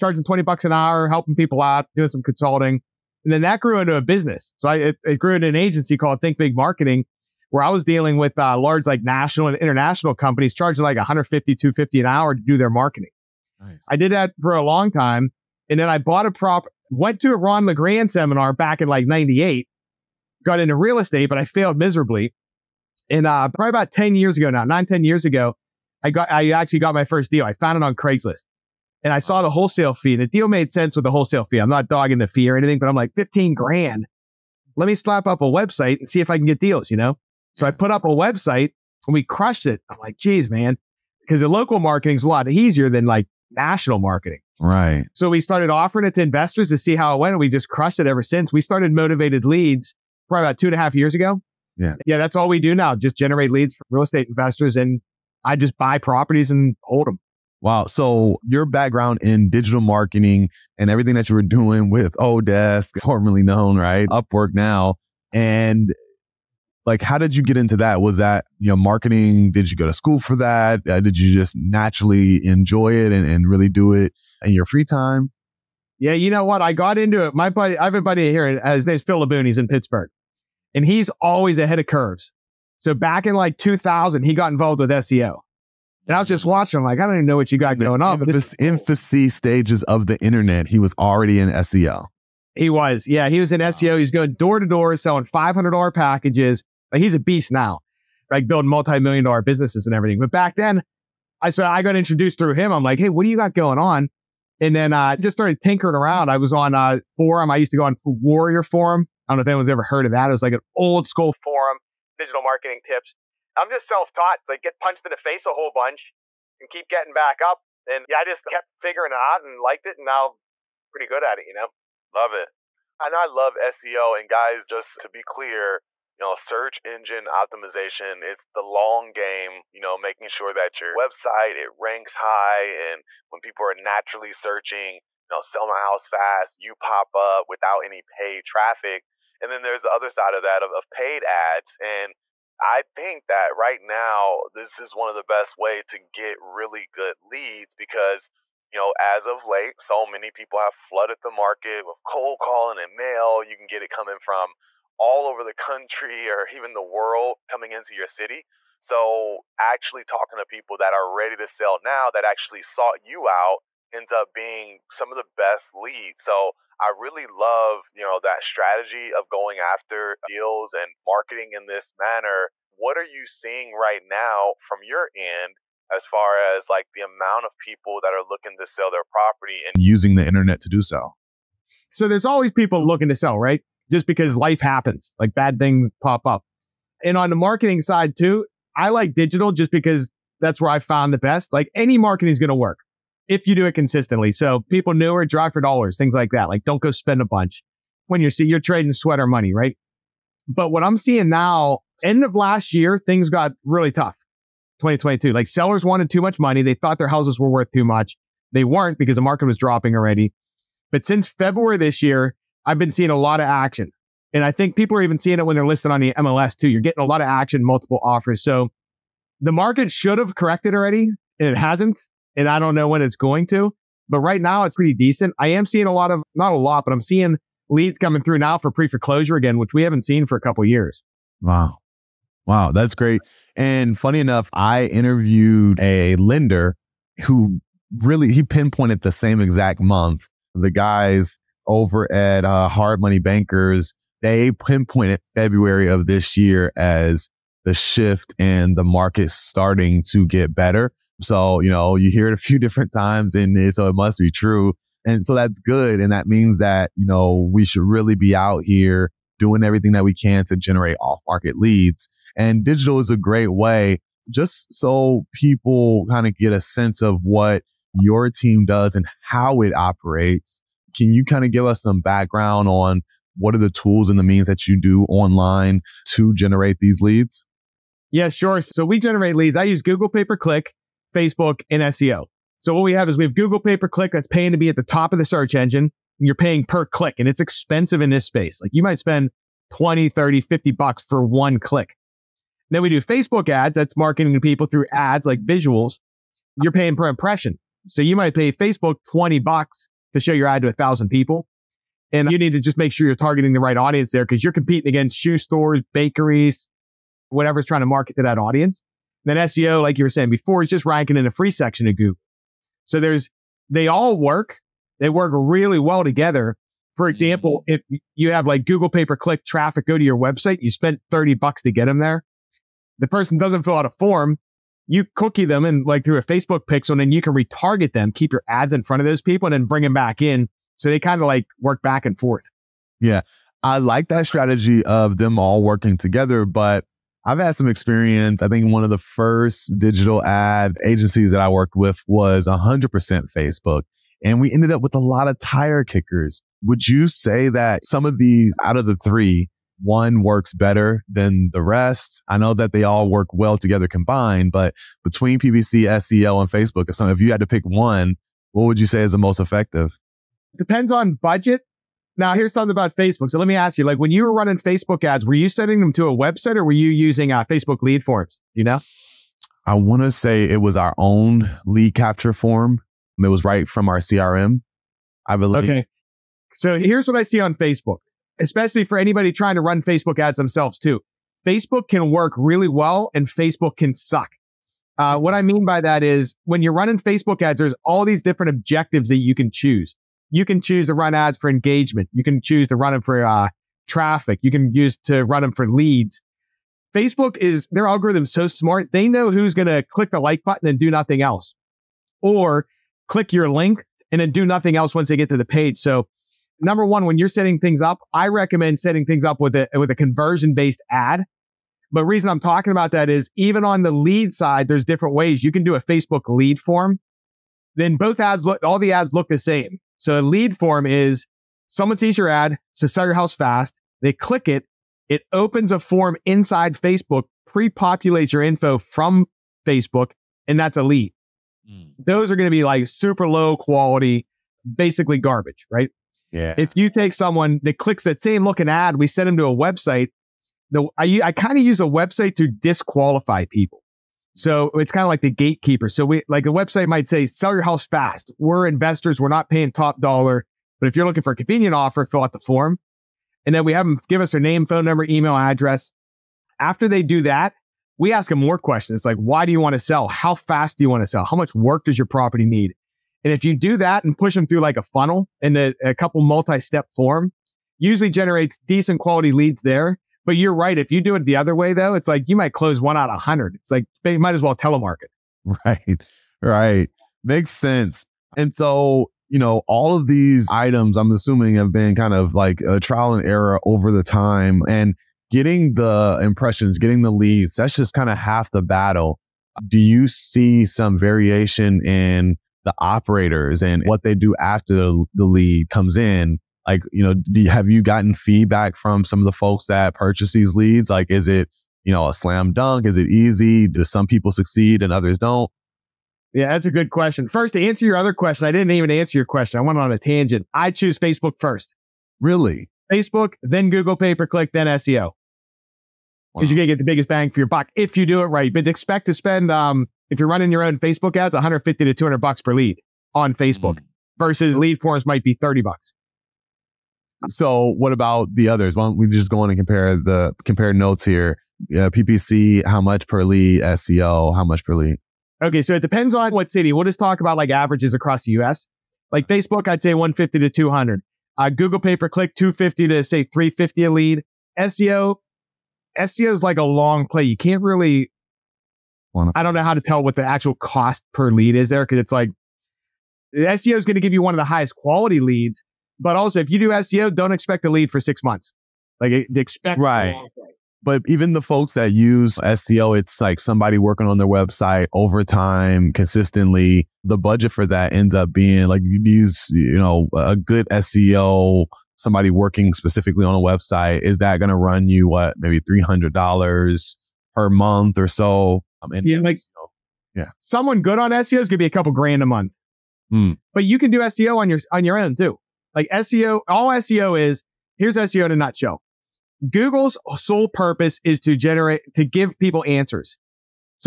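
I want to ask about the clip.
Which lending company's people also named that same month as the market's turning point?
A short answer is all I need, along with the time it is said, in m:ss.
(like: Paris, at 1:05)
Hard Money Bankers, at 4:02.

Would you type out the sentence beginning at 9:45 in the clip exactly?
Like SEO, all SEO is here's SEO in a nutshell.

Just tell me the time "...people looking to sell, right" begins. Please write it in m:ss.
3:02.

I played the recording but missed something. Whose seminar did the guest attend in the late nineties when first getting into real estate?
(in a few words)
Ron LeGrand.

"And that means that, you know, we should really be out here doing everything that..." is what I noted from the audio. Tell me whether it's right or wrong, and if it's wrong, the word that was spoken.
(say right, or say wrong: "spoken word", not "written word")
right.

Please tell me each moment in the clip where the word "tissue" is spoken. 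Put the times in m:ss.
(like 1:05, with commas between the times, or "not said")
not said.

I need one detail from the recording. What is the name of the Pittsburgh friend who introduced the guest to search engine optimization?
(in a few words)
Phil Laboon.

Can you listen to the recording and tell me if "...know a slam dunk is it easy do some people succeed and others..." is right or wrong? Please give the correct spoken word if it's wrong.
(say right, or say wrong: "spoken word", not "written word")
right.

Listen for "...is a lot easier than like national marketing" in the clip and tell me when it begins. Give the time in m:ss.
0:42.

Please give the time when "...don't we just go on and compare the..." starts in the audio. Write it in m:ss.
8:48.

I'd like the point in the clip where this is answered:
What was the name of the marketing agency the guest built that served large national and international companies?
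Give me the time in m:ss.
0:06.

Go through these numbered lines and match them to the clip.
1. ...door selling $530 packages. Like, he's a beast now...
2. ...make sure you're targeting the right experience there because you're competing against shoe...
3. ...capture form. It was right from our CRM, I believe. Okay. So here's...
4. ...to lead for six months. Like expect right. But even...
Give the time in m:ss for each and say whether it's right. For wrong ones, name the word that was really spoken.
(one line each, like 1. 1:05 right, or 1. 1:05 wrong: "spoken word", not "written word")
1. 1:34 wrong: "500", not "530"
2. 5:02 wrong: "audience", not "experience"
3. 6:11 right
4. 9:17 right.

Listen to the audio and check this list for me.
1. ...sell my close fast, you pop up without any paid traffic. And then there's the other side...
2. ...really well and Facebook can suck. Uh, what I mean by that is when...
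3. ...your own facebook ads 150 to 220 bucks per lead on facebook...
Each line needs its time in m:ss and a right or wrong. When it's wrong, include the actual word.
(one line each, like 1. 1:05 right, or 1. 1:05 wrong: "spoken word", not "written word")
1. 2:15 wrong: "house", not "close"
2. 6:22 right
3. 8:40 wrong: "200", not "220".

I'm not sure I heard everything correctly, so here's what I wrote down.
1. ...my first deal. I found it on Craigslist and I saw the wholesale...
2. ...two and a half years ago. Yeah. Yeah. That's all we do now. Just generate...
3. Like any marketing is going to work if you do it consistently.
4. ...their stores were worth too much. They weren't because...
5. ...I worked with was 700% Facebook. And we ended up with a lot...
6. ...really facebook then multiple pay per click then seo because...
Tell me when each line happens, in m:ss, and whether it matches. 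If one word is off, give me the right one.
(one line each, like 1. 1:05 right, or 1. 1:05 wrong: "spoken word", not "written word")
1. 0:26 right
2. 0:50 right
3. 3:11 right
4. 3:26 wrong: "houses", not "stores"
5. 5:41 wrong: "100", not "700"
6. 8:32 wrong: "google", not "multiple".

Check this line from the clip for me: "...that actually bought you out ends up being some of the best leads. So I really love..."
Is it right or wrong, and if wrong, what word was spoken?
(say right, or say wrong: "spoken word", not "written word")
wrong: "sought", not "bought".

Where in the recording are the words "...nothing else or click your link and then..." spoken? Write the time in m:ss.
6:40.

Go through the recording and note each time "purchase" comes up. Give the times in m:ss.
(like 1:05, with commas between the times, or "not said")
8:19.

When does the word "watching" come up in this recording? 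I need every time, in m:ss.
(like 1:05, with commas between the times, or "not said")
1:26.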